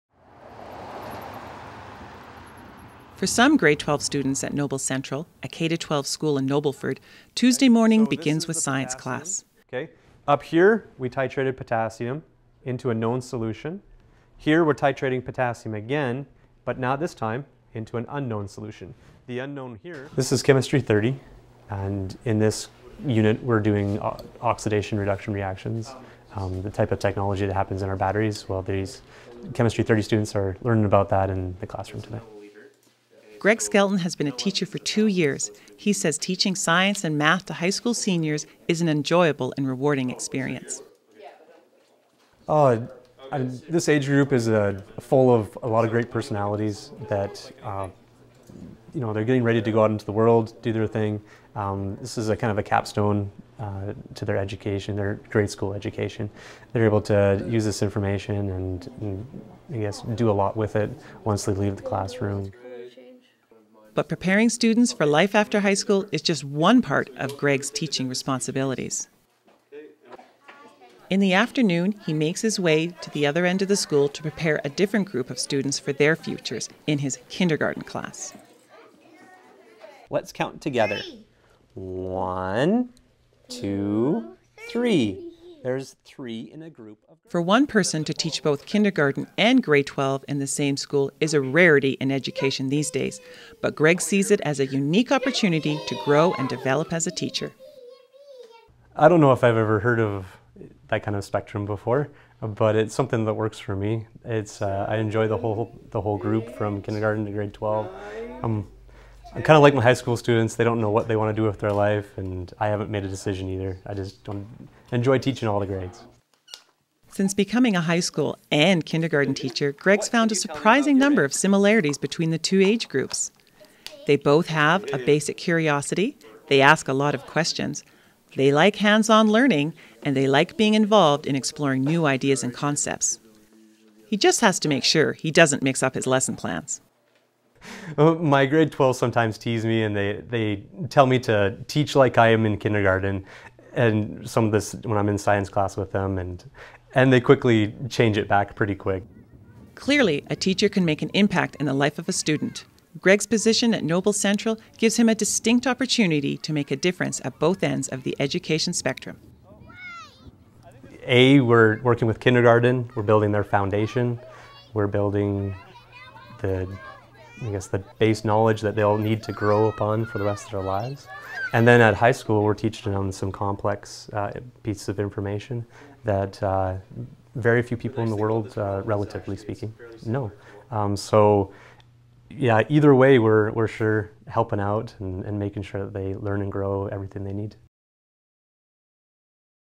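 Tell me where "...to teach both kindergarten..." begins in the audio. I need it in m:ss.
1:28.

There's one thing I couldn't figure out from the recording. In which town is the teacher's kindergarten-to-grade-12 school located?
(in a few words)
Nobleford.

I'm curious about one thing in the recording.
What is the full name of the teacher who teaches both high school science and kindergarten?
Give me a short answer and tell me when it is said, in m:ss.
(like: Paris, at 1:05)
Greg Skelton, at 0:33.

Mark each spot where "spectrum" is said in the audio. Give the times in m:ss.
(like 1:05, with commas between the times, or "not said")
1:41, 2:38.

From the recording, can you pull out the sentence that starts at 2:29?
Clearly, a teacher can make an impact in the life of a student.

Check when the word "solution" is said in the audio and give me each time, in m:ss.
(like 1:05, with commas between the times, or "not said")
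0:13, 0:18.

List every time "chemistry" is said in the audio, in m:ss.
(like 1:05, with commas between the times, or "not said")
0:20, 0:29.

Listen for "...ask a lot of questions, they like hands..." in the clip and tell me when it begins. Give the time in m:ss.
2:06.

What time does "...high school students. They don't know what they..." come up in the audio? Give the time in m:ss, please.
1:49.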